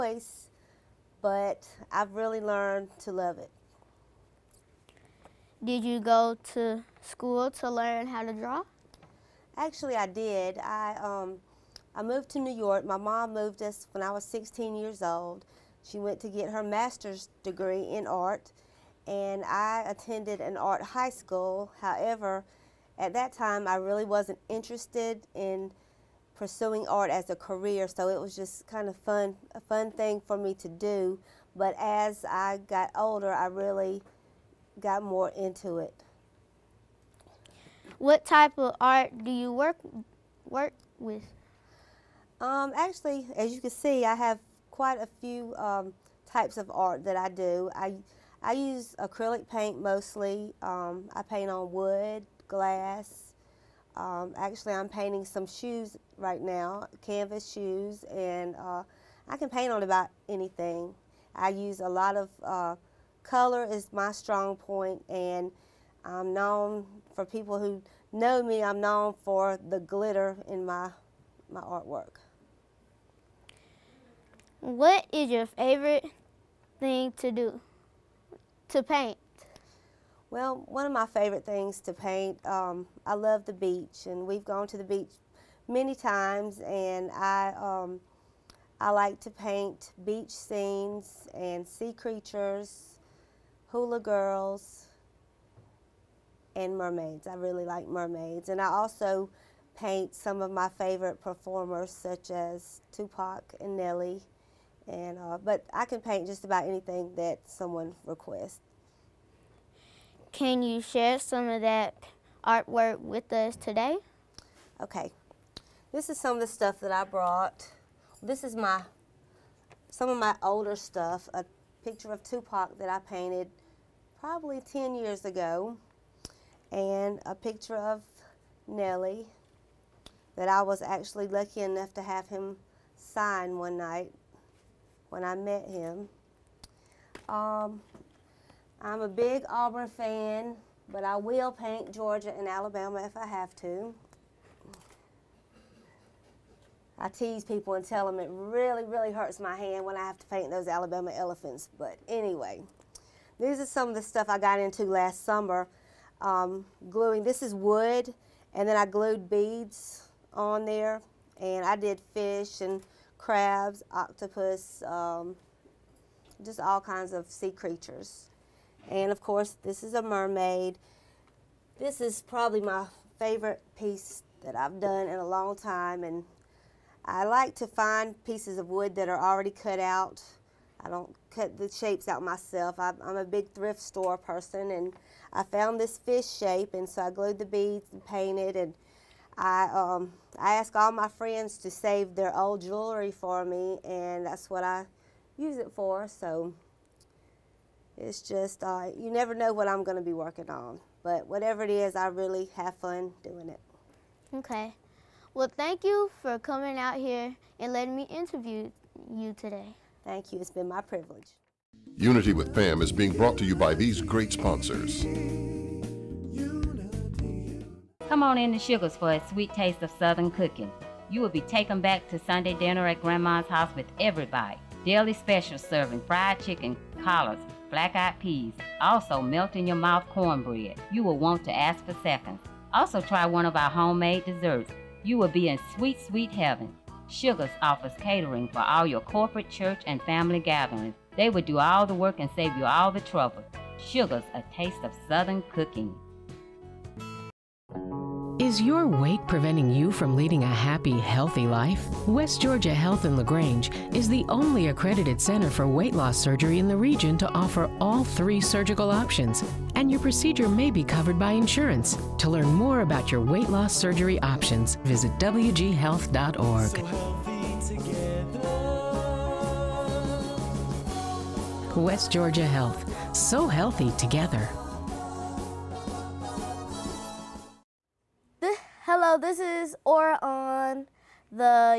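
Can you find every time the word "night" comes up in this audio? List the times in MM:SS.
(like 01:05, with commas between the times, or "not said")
02:13.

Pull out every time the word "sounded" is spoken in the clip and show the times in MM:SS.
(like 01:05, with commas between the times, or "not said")
not said.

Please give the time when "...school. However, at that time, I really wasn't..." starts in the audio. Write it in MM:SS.
00:21.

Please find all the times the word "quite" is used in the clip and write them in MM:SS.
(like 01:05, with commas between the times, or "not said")
00:44.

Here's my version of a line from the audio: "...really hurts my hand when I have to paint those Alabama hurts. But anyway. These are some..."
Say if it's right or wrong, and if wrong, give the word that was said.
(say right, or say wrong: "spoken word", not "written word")
wrong: "elephants", not "hurts".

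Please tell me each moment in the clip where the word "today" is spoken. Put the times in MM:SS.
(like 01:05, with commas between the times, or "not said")
01:53, 03:29.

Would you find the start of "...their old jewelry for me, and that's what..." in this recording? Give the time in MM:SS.
03:12.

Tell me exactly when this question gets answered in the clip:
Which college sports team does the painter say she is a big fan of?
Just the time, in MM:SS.
02:19.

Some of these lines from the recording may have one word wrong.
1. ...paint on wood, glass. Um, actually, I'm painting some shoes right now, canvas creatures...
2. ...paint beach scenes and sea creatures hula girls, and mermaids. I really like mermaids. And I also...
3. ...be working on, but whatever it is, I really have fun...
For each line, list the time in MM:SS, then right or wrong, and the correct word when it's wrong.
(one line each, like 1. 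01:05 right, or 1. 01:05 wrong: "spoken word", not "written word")
1. 00:51 wrong: "shoes", not "creatures"
2. 01:29 right
3. 03:20 right.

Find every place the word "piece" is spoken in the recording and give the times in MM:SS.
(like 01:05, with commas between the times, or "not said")
02:53, 02:58.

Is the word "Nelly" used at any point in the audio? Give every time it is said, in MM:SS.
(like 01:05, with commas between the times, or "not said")
01:43, 02:08.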